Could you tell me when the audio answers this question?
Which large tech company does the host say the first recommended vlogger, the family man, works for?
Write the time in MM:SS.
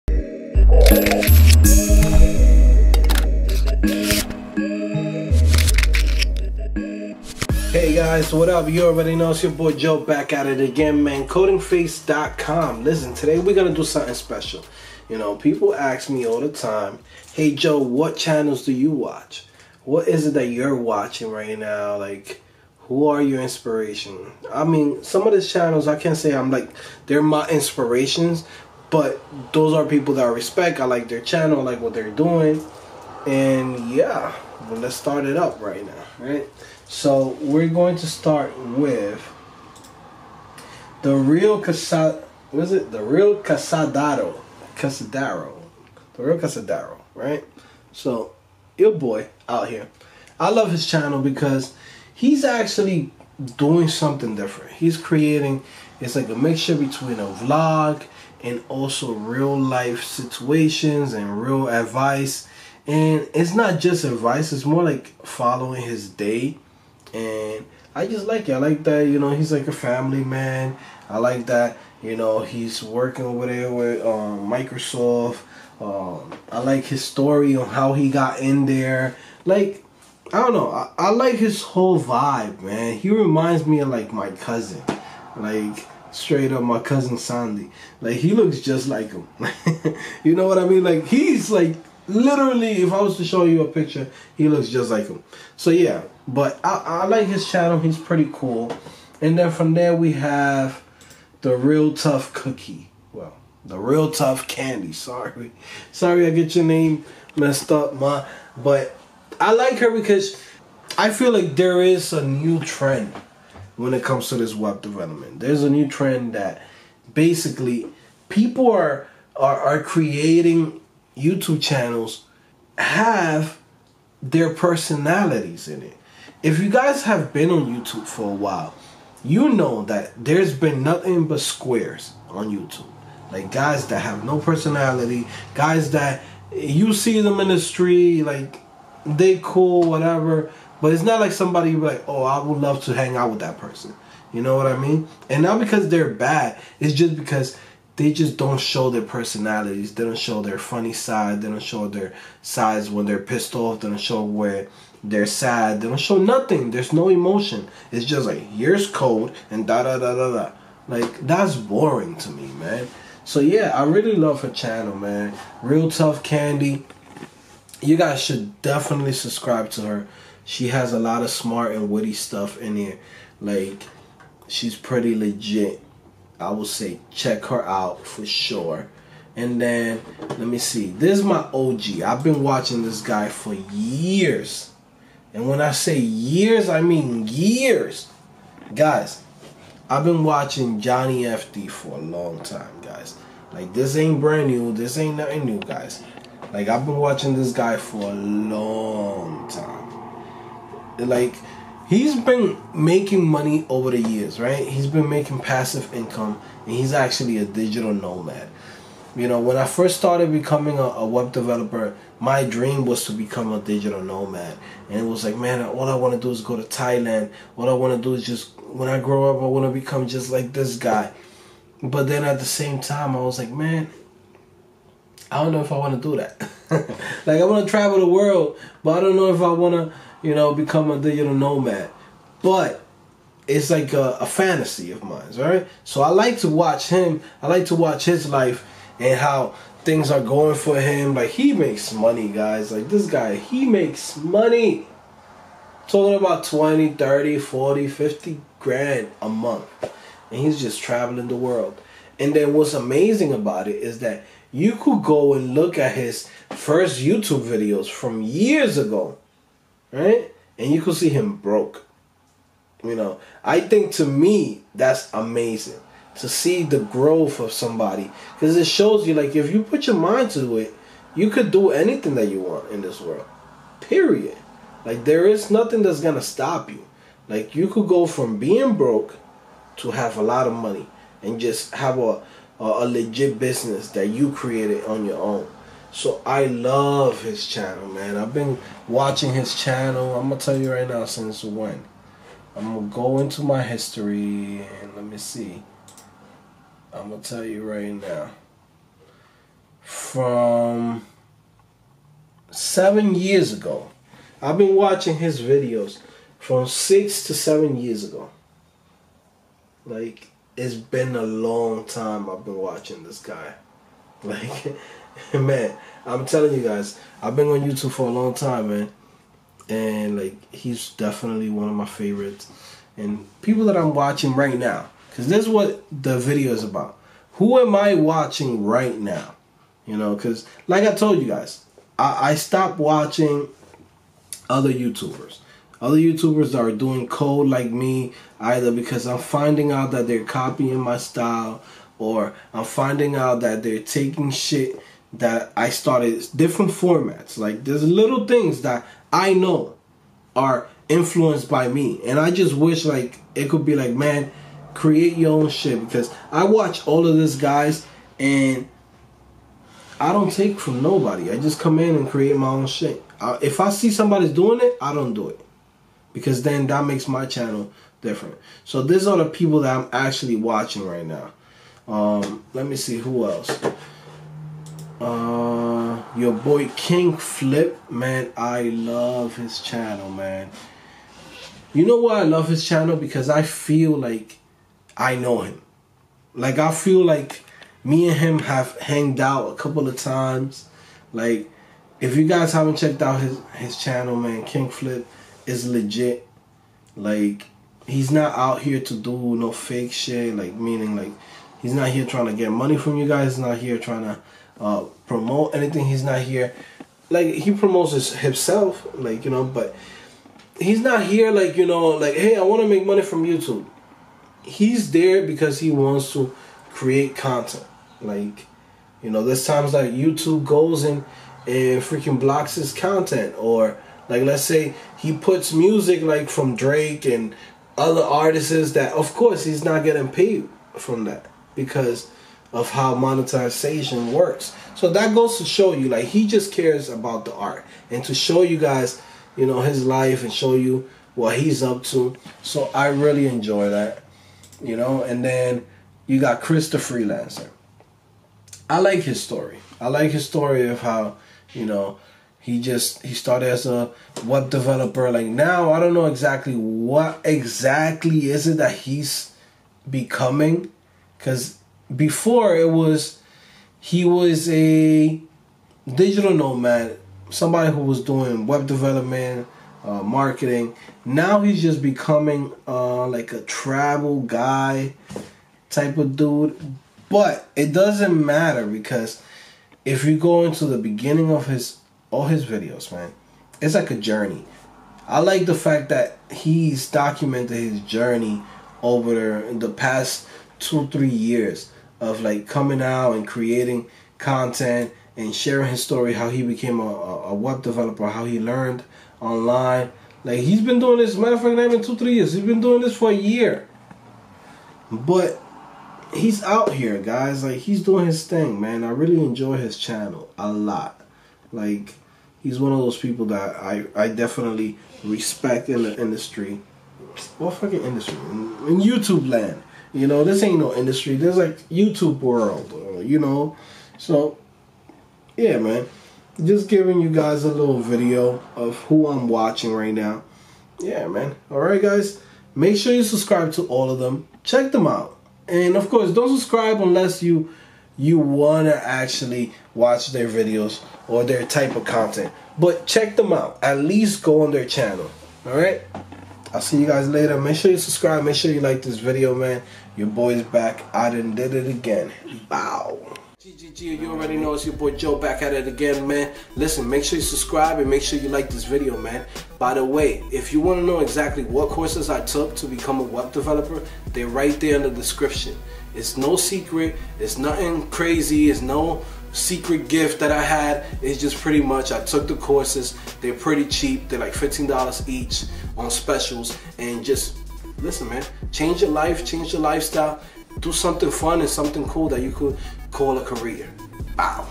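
01:14.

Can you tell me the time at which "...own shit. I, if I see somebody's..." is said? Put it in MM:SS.
06:02.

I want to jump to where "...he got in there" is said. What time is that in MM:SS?
01:17.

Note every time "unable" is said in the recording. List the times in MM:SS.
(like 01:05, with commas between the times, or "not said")
not said.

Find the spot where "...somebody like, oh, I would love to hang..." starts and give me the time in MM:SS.
02:21.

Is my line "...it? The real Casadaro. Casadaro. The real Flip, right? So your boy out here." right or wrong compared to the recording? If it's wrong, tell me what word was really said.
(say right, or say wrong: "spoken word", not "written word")
wrong: "Casadaro", not "Flip".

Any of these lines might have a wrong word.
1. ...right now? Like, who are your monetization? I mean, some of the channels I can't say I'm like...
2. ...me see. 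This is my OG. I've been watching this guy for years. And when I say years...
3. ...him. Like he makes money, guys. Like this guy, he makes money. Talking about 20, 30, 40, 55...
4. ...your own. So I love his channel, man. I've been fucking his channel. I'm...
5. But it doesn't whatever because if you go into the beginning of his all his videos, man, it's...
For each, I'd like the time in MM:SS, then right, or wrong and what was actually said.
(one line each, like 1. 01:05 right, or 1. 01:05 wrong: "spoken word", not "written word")
1. 00:21 wrong: "inspiration", not "monetization"
2. 03:00 right
3. 04:00 wrong: "50", not "55"
4. 04:45 wrong: "watching", not "fucking"
5. 07:57 wrong: "matter", not "whatever".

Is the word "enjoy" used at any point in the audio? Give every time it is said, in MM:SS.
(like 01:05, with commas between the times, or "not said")
07:23, 08:29.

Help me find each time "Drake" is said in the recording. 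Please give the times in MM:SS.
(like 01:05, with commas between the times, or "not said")
07:06.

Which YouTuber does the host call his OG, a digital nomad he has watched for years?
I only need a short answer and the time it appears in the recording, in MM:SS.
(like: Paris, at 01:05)
Johnny FD, at 03:10.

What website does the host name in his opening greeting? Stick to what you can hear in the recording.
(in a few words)
CodingPhase.com.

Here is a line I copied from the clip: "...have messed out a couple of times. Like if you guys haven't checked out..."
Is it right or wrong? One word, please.
wrong.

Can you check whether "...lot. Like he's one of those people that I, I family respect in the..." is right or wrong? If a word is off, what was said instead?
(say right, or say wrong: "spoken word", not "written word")
wrong: "definitely", not "family".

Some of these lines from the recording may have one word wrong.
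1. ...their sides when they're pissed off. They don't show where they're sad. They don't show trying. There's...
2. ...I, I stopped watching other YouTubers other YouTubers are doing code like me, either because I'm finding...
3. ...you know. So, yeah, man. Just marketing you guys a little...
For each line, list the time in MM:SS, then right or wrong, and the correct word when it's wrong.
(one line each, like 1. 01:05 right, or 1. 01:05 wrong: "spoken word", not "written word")
1. 02:31 wrong: "nothing", not "trying"
2. 05:31 right
3. 08:42 wrong: "giving", not "marketing".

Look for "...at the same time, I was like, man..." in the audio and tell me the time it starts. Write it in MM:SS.
03:42.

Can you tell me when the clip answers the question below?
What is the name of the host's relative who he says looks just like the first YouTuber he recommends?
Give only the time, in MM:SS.
01:27.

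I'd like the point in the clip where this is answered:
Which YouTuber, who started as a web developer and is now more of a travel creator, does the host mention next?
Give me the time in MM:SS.
07:26.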